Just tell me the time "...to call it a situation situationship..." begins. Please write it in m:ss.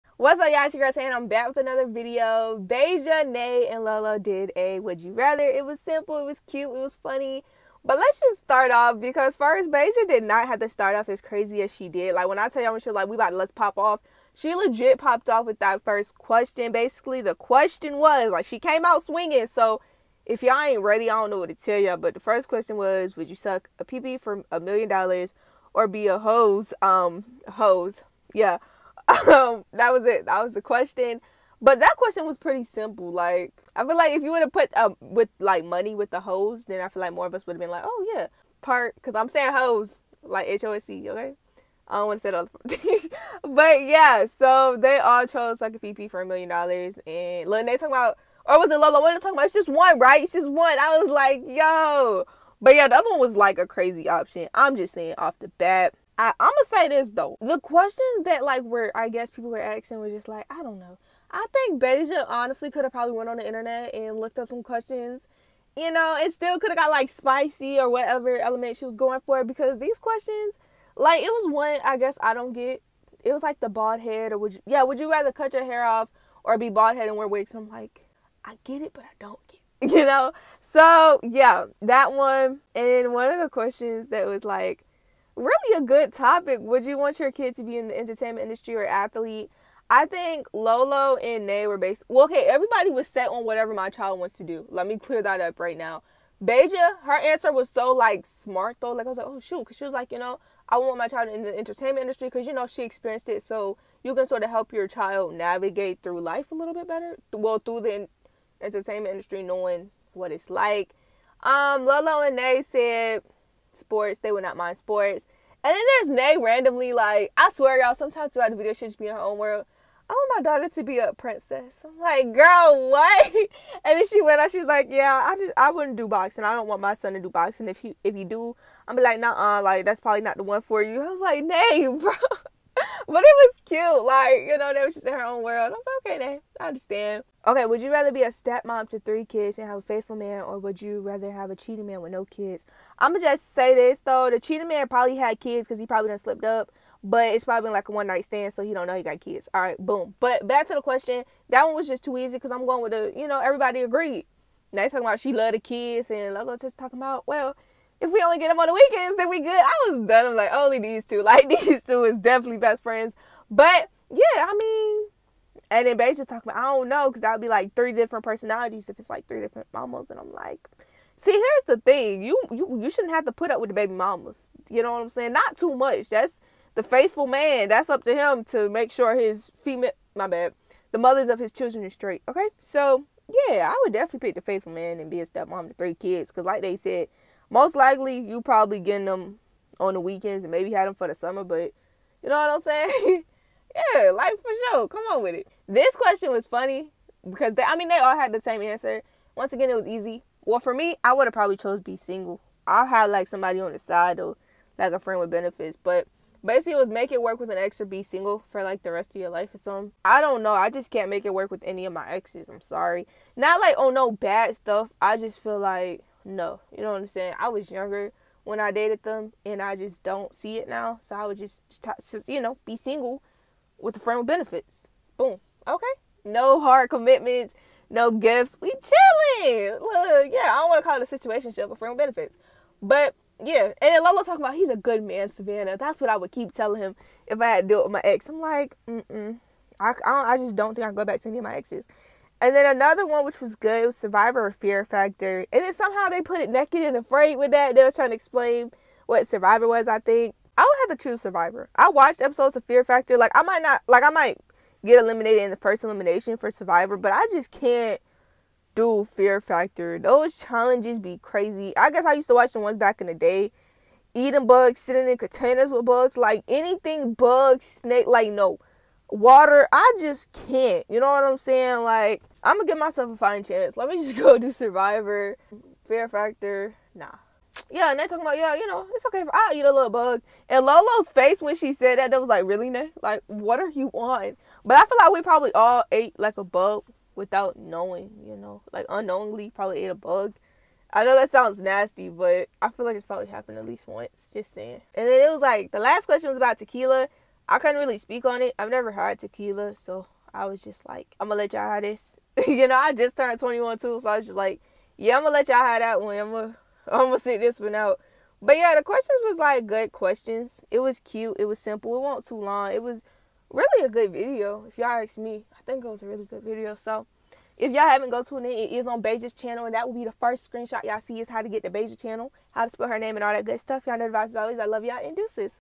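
3:50.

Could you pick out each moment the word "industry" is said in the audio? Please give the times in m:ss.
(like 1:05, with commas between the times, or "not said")
1:28, 1:41, 1:49.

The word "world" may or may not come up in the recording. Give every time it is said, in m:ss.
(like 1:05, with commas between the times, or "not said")
1:59, 2:15.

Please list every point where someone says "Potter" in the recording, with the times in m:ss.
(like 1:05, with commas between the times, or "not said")
not said.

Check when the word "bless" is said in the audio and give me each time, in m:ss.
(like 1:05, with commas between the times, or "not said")
not said.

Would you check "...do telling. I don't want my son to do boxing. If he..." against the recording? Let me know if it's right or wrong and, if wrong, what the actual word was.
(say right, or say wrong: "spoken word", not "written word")
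wrong: "boxing", not "telling".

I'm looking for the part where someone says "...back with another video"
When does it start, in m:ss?
0:01.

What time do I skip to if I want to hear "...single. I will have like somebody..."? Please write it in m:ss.
3:21.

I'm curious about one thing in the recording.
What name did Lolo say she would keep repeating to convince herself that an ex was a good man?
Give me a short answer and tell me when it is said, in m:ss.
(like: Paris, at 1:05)
Savannah, at 3:55.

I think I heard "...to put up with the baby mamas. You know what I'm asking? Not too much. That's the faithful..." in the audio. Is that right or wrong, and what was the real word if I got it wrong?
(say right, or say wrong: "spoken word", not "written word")
wrong: "saying", not "asking".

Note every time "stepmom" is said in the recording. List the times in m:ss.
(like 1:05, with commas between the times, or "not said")
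2:18, 3:05.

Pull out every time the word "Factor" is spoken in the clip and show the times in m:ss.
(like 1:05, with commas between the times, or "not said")
4:04, 4:12, 4:19, 4:36.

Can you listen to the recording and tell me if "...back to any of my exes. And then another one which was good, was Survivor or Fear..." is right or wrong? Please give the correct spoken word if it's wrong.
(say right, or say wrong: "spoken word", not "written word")
right.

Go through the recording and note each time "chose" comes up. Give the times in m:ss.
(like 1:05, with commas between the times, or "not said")
0:45, 3:21.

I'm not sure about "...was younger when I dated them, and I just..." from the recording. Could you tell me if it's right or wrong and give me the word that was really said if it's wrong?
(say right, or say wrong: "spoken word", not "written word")
right.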